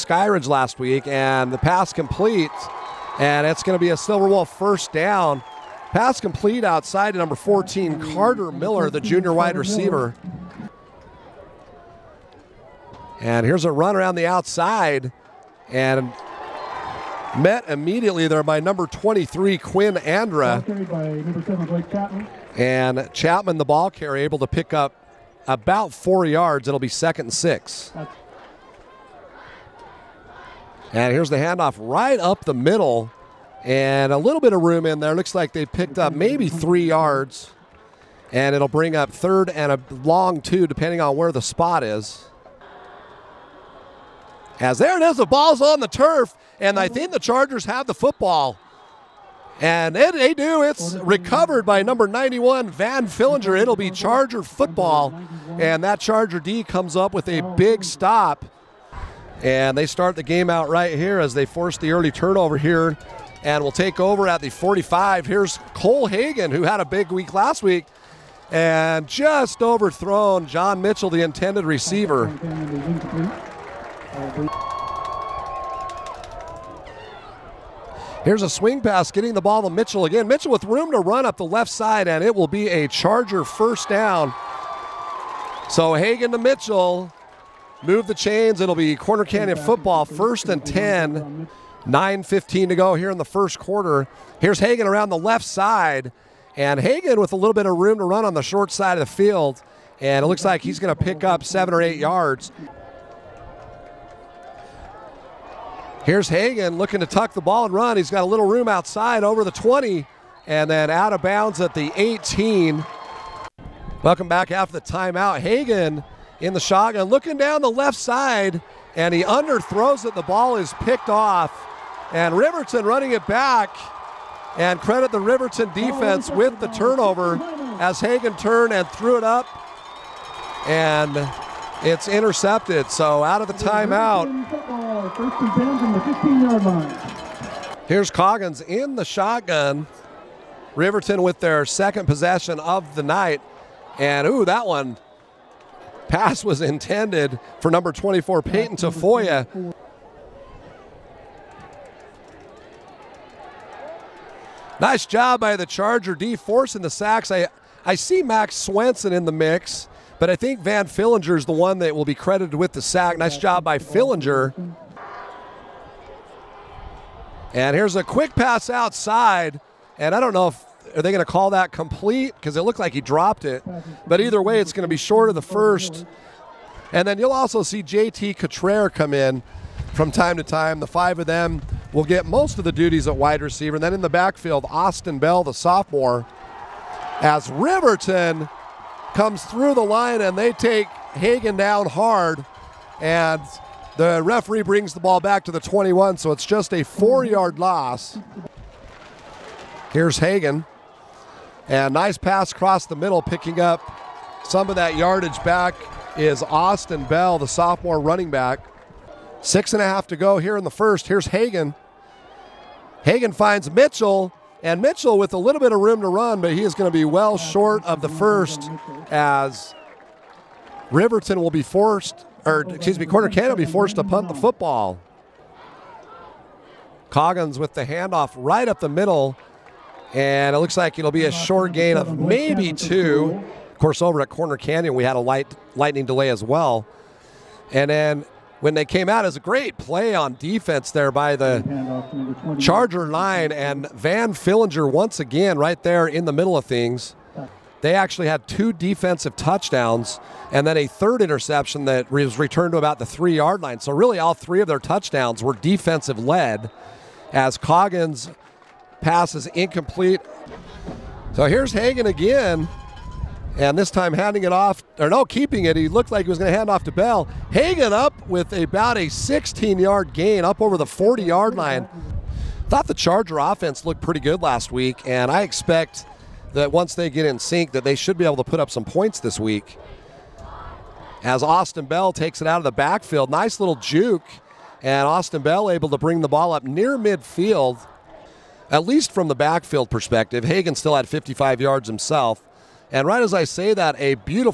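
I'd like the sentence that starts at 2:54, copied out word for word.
But either way, it's going to be short of the first.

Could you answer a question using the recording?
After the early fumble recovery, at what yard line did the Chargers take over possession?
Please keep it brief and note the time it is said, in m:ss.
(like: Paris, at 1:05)
45, at 1:04.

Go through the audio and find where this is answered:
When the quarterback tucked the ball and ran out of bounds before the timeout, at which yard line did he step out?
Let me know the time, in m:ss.
1:51.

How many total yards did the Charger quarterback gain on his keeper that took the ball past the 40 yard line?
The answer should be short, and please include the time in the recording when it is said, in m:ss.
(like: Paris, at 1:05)
16, at 4:29.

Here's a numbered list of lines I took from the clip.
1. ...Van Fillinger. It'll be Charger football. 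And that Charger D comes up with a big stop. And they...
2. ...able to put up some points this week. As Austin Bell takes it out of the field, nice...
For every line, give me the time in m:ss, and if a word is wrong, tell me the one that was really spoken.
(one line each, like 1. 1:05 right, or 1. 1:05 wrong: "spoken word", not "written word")
1. 0:52 right
2. 4:38 wrong: "backfield", not "field".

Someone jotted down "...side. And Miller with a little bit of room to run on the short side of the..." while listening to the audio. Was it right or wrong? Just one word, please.
wrong.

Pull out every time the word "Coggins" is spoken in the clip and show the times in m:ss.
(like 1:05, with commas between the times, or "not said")
2:18, 3:47, 4:17.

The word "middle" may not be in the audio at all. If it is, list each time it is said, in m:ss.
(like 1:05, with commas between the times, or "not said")
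0:32, 3:22, 3:48, 4:06.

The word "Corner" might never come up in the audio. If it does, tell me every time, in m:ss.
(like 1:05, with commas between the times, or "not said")
1:28, 3:43, 3:54.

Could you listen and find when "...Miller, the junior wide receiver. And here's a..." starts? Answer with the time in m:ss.
0:08.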